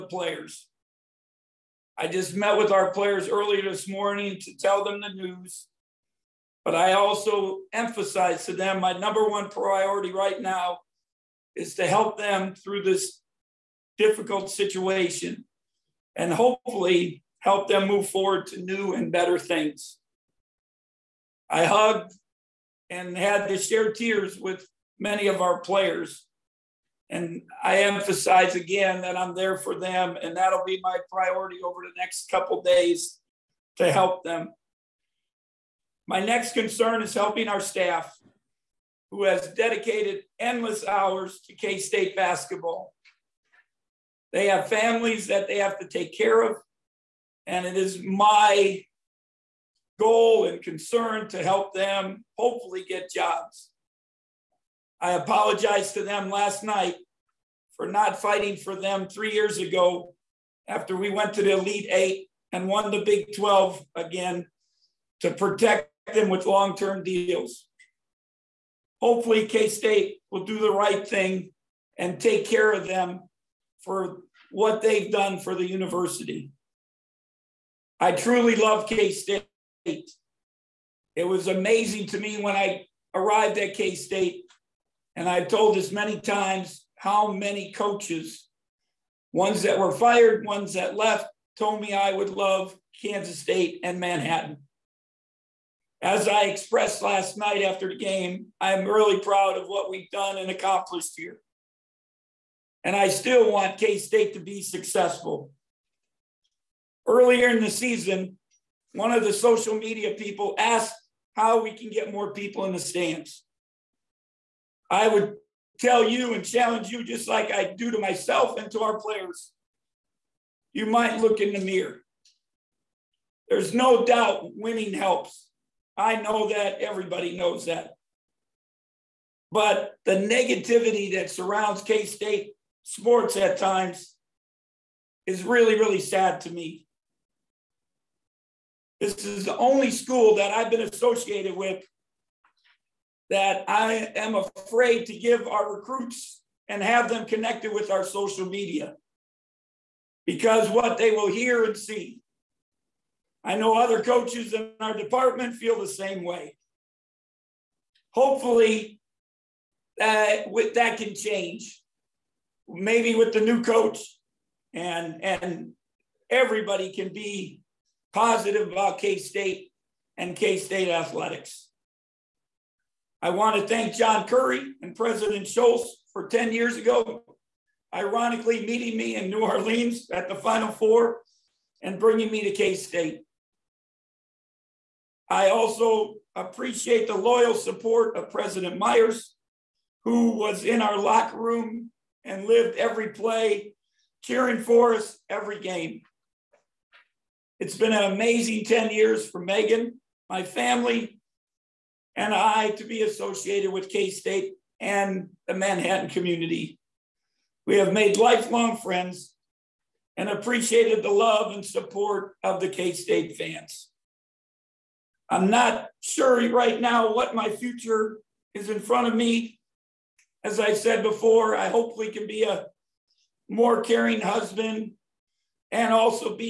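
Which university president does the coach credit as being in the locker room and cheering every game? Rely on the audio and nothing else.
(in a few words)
President Myers.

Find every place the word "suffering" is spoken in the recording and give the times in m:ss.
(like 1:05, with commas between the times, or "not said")
not said.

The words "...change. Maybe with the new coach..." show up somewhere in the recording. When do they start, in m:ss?
2:41.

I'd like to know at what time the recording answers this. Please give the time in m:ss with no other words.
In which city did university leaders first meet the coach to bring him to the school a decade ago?
2:59.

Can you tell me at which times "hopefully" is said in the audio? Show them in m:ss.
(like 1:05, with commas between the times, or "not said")
0:16, 0:52, 1:09, 2:38, 3:41.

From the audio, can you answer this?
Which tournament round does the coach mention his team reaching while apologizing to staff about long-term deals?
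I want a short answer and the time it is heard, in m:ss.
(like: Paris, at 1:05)
Elite Eight, at 1:01.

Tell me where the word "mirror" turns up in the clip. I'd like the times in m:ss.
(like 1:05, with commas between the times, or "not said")
2:01.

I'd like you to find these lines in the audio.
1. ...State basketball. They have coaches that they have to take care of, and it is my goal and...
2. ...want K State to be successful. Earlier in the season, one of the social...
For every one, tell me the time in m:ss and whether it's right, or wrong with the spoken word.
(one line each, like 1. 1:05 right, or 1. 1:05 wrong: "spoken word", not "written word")
1. 0:41 wrong: "families", not "coaches"
2. 1:43 right.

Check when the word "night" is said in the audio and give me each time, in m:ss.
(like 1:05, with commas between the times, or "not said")
0:56, 1:37.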